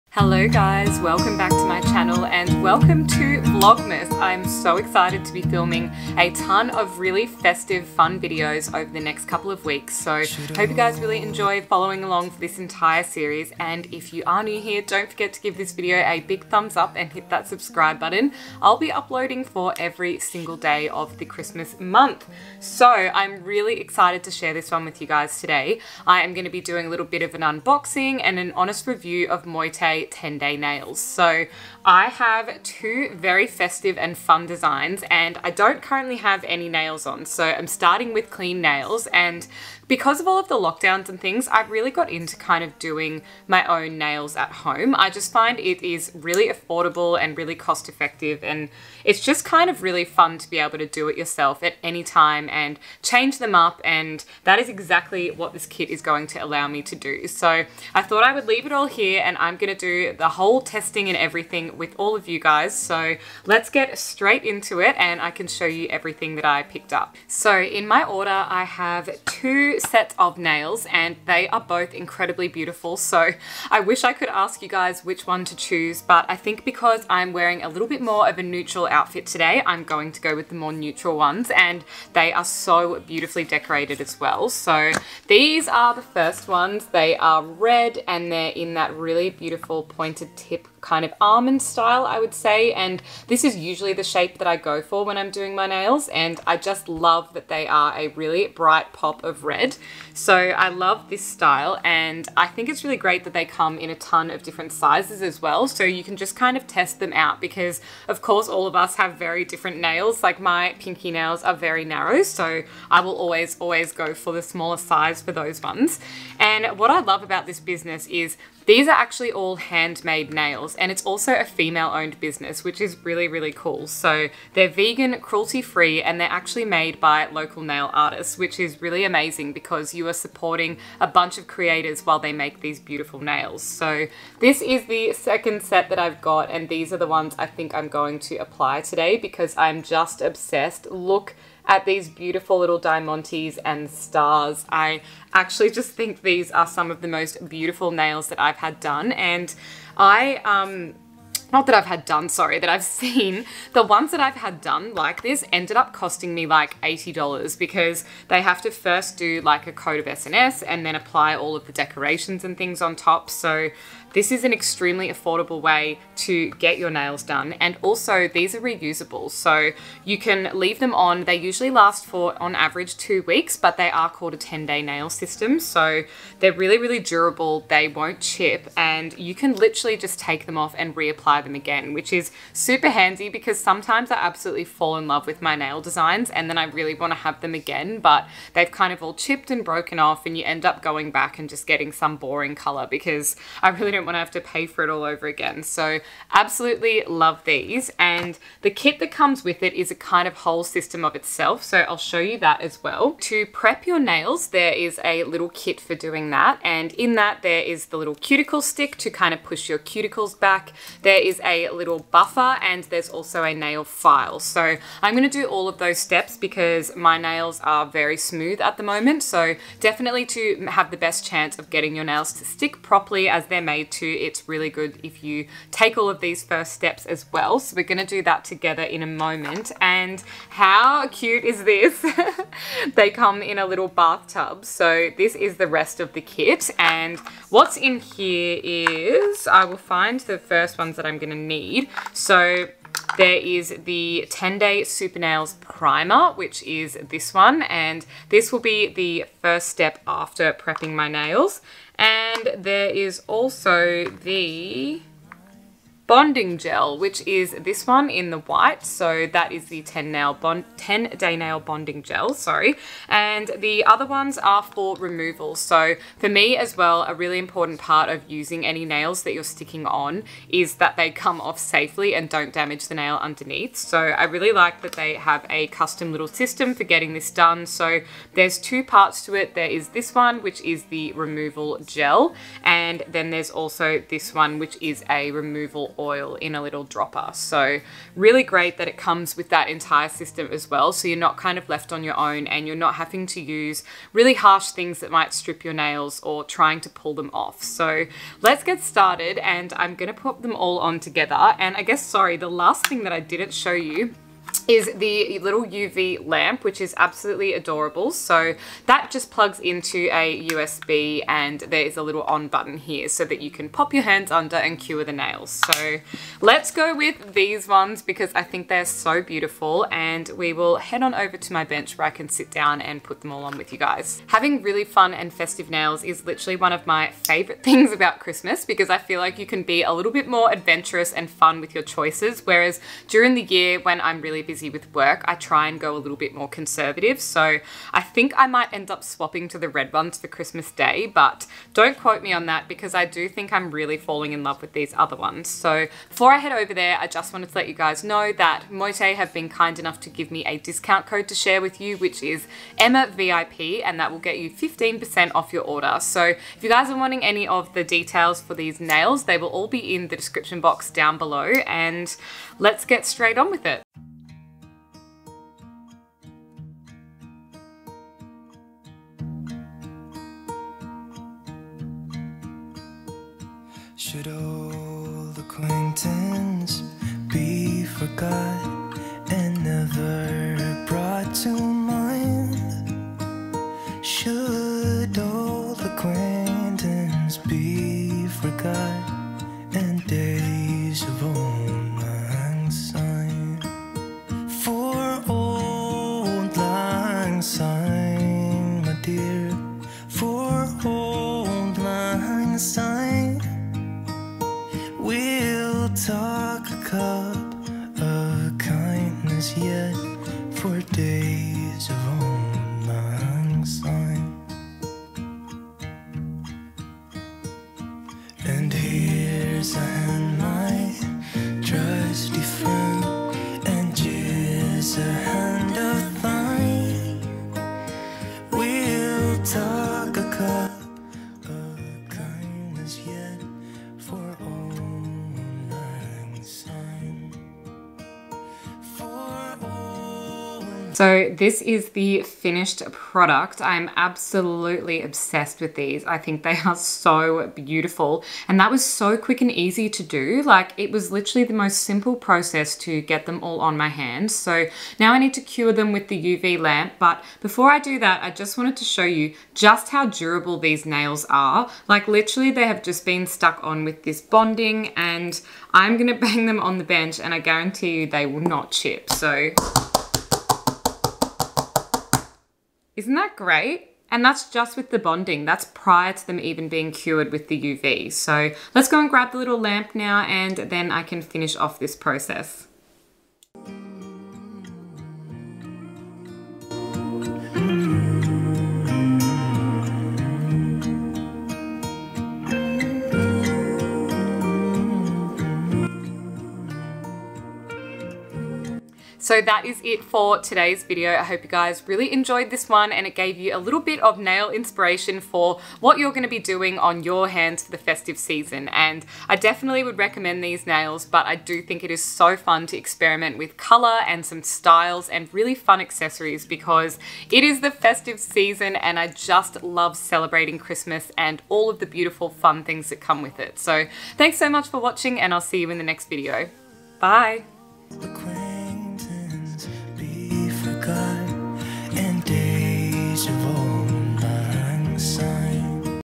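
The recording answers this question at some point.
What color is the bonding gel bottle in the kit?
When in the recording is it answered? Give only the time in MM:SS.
04:18.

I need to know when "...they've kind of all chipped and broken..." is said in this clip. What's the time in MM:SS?
03:08.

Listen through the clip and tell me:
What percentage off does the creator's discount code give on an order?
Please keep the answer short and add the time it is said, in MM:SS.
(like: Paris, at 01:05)
15%, at 05:54.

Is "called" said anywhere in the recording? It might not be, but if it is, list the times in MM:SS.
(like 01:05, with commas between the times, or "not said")
02:54.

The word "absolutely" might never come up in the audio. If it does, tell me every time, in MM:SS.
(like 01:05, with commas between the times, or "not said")
03:04, 03:16, 05:06, 07:23.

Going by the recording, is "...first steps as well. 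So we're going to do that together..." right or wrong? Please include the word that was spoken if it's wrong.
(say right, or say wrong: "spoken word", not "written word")
right.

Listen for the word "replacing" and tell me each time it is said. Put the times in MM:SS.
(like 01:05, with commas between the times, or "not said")
not said.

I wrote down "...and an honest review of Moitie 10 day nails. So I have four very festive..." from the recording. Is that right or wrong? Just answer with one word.
wrong.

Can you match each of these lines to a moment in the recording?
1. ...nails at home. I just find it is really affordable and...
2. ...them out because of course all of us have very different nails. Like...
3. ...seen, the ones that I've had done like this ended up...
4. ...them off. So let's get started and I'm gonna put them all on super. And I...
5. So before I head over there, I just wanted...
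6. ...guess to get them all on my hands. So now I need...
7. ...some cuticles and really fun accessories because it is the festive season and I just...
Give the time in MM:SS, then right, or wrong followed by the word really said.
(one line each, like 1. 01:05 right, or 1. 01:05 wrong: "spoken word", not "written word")
1. 00:43 right
2. 01:46 right
3. 02:32 right
4. 04:57 wrong: "together", not "super"
5. 05:45 right
6. 07:32 wrong: "process", not "guess"
7. 08:34 wrong: "styles", not "cuticles".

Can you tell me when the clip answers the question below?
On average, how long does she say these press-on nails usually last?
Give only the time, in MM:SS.
02:52.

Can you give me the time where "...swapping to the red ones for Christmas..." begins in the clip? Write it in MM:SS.
05:39.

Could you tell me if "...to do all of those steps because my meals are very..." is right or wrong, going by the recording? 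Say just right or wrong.
wrong.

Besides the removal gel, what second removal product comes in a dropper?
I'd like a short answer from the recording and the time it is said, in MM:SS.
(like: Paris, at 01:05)
removal oil, at 04:45.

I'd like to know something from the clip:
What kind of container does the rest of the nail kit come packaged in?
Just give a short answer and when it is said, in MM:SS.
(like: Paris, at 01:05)
a little bathtub, at 03:53.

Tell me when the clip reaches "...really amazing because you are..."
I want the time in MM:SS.
02:08.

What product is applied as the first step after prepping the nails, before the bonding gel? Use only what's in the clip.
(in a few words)
Super Nails Primer.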